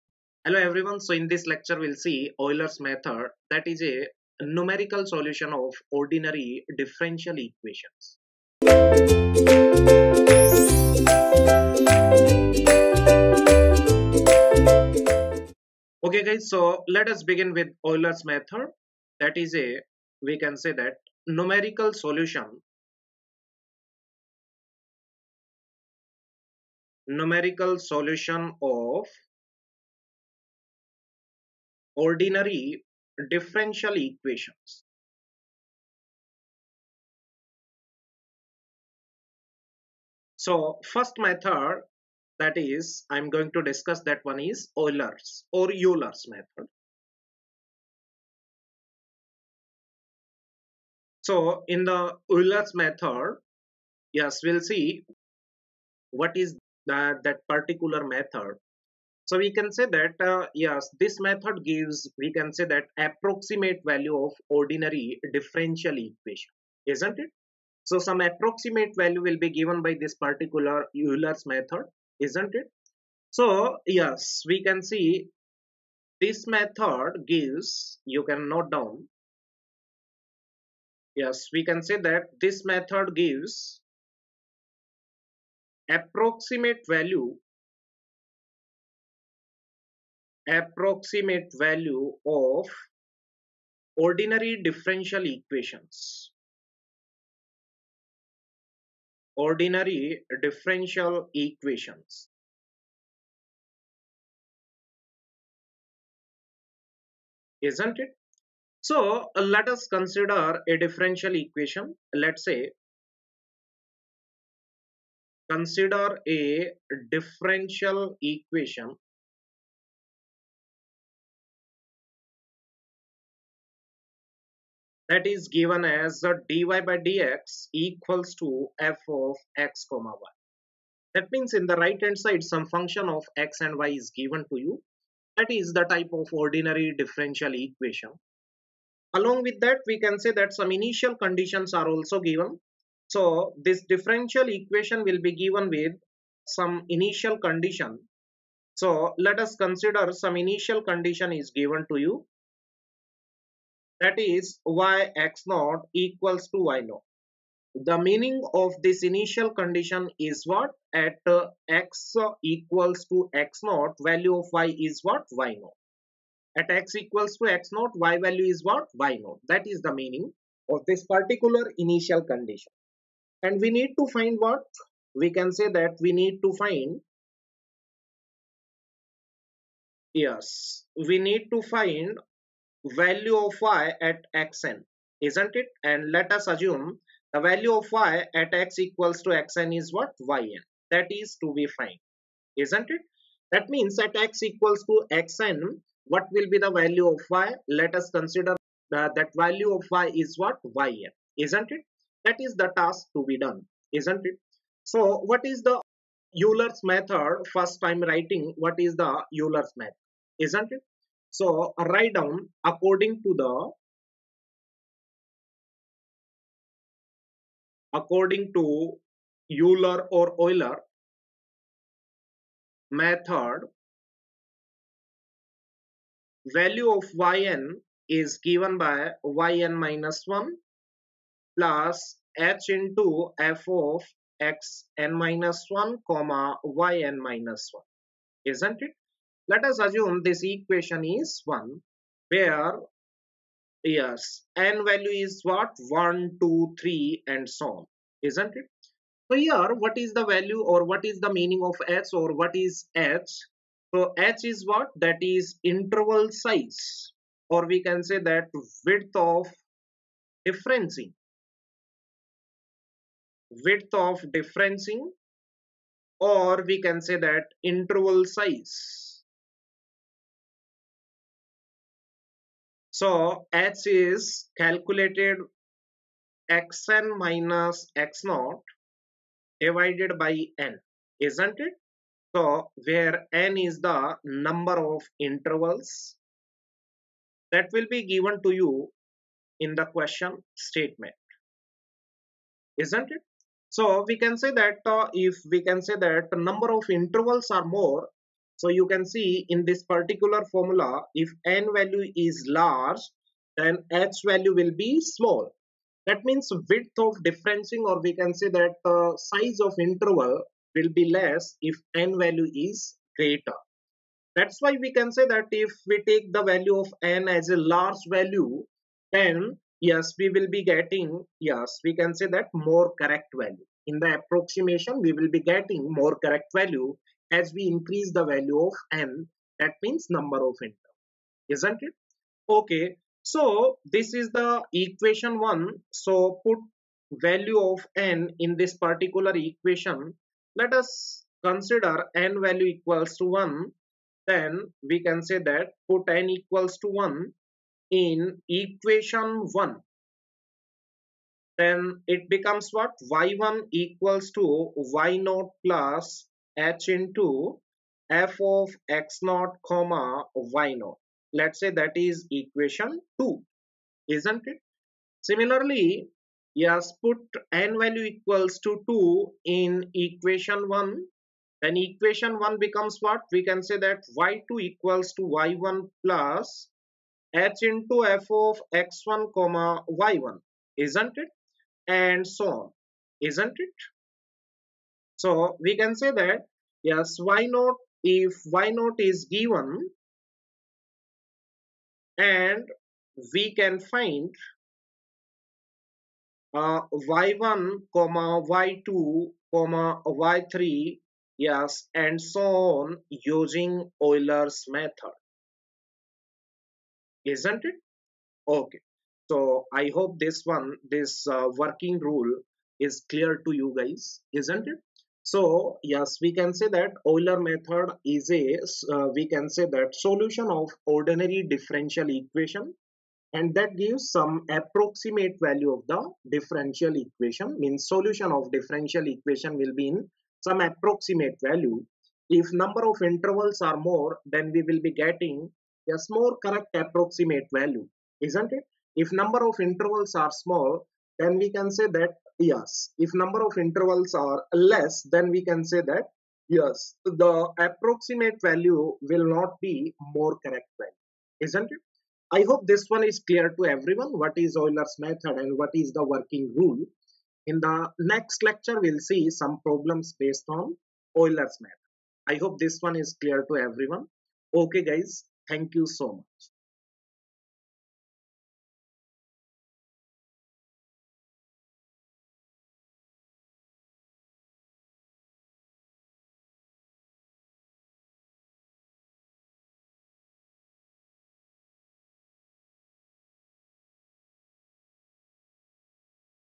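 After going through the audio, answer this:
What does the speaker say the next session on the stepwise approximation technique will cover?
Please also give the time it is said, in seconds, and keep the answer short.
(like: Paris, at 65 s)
problems, at 458 s.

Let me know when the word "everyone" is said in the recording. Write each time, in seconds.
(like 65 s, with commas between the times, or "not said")
0 s, 453 s, 463 s.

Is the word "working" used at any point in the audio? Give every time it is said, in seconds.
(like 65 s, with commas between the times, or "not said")
411 s, 456 s.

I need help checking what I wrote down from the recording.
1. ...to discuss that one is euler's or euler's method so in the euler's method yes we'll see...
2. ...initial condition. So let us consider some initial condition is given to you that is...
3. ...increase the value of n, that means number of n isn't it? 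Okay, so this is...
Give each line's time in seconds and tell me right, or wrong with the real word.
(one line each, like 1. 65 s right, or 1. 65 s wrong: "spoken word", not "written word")
1. 43 s right
2. 146 s right
3. 327 s right.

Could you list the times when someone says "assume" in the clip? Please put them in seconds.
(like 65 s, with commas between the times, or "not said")
186 s, 239 s.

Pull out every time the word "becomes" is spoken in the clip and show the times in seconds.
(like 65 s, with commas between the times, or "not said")
352 s, 372 s.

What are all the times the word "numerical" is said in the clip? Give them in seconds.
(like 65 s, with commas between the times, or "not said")
4 s, 21 s, 27 s.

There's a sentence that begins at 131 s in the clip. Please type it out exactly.
That means in the right hand side some function of x and y is given to you.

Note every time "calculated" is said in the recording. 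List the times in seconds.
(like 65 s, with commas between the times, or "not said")
274 s.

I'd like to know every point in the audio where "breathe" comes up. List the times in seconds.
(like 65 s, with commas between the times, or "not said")
not said.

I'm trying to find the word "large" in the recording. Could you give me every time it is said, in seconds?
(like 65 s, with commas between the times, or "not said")
302 s, 317 s.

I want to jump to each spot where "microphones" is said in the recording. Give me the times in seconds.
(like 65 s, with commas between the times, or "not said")
not said.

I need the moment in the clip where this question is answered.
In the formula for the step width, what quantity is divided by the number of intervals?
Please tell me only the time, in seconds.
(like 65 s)
276 s.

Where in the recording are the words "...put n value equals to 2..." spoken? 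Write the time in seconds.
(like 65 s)
367 s.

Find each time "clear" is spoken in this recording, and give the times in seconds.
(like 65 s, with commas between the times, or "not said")
413 s, 453 s, 463 s.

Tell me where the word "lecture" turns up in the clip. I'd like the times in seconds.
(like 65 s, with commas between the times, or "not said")
1 s, 458 s.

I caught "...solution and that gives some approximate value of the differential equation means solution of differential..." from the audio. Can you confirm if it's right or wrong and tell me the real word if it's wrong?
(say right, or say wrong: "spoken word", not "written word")
wrong: "equation", not "solution".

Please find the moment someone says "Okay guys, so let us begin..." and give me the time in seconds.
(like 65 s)
16 s.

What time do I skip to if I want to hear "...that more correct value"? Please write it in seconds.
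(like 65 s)
322 s.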